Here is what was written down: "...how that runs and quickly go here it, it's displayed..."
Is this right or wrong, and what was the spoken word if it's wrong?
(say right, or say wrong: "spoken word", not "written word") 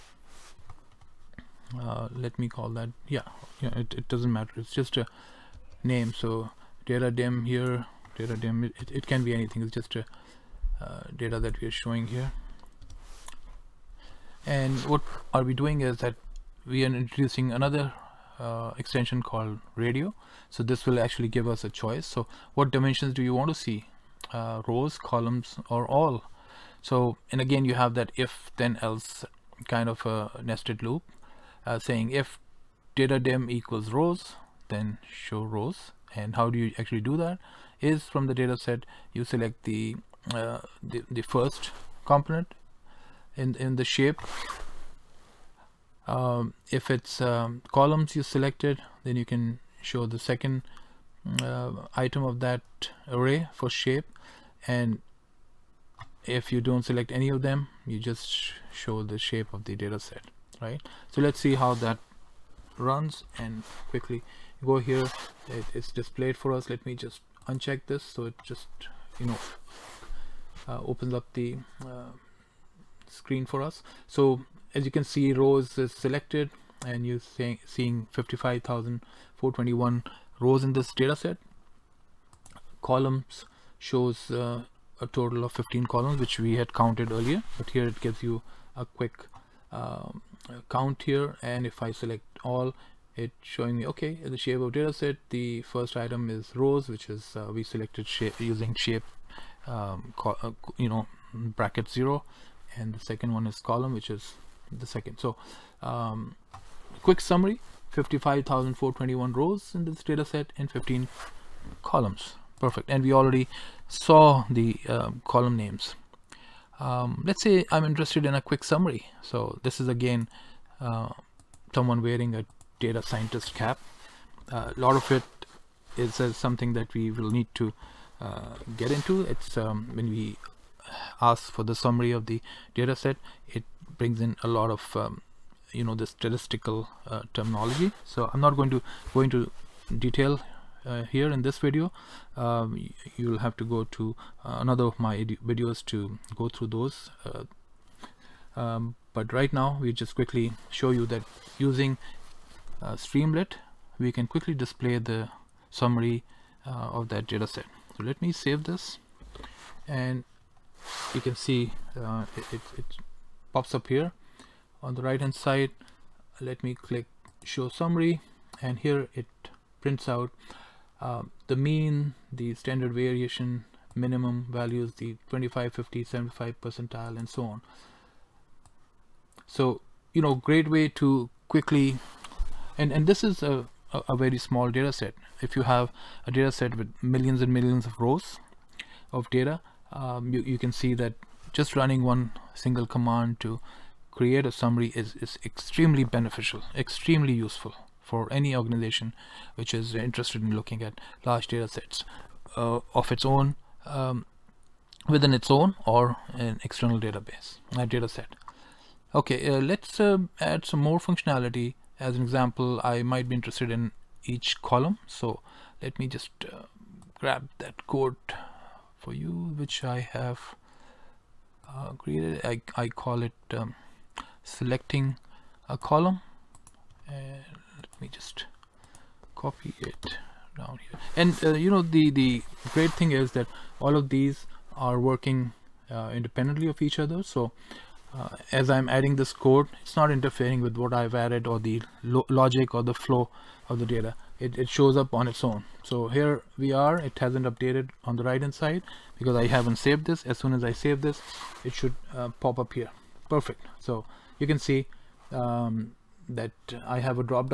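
right.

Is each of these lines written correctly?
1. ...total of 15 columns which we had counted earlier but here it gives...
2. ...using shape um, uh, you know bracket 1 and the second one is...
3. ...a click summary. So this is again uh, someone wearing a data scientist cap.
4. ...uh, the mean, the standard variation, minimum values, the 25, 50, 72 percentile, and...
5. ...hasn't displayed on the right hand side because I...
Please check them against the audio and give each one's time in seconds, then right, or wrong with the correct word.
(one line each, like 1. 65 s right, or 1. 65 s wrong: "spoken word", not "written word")
1. 85 s right
2. 98 s wrong: "0", not "1"
3. 118 s wrong: "quick", not "click"
4. 170 s wrong: "75", not "72"
5. 247 s wrong: "updated", not "displayed".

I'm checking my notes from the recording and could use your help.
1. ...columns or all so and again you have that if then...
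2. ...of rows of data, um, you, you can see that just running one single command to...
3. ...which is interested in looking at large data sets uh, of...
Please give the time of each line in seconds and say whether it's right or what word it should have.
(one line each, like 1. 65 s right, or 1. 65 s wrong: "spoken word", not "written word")
1. 24 s right
2. 187 s right
3. 199 s right.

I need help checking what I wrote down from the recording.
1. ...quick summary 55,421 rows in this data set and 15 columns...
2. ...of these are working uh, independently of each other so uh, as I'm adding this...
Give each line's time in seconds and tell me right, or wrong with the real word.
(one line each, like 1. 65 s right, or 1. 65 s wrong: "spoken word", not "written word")
1. 107 s right
2. 233 s right.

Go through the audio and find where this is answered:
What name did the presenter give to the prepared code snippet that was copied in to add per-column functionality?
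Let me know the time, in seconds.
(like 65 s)
224 s.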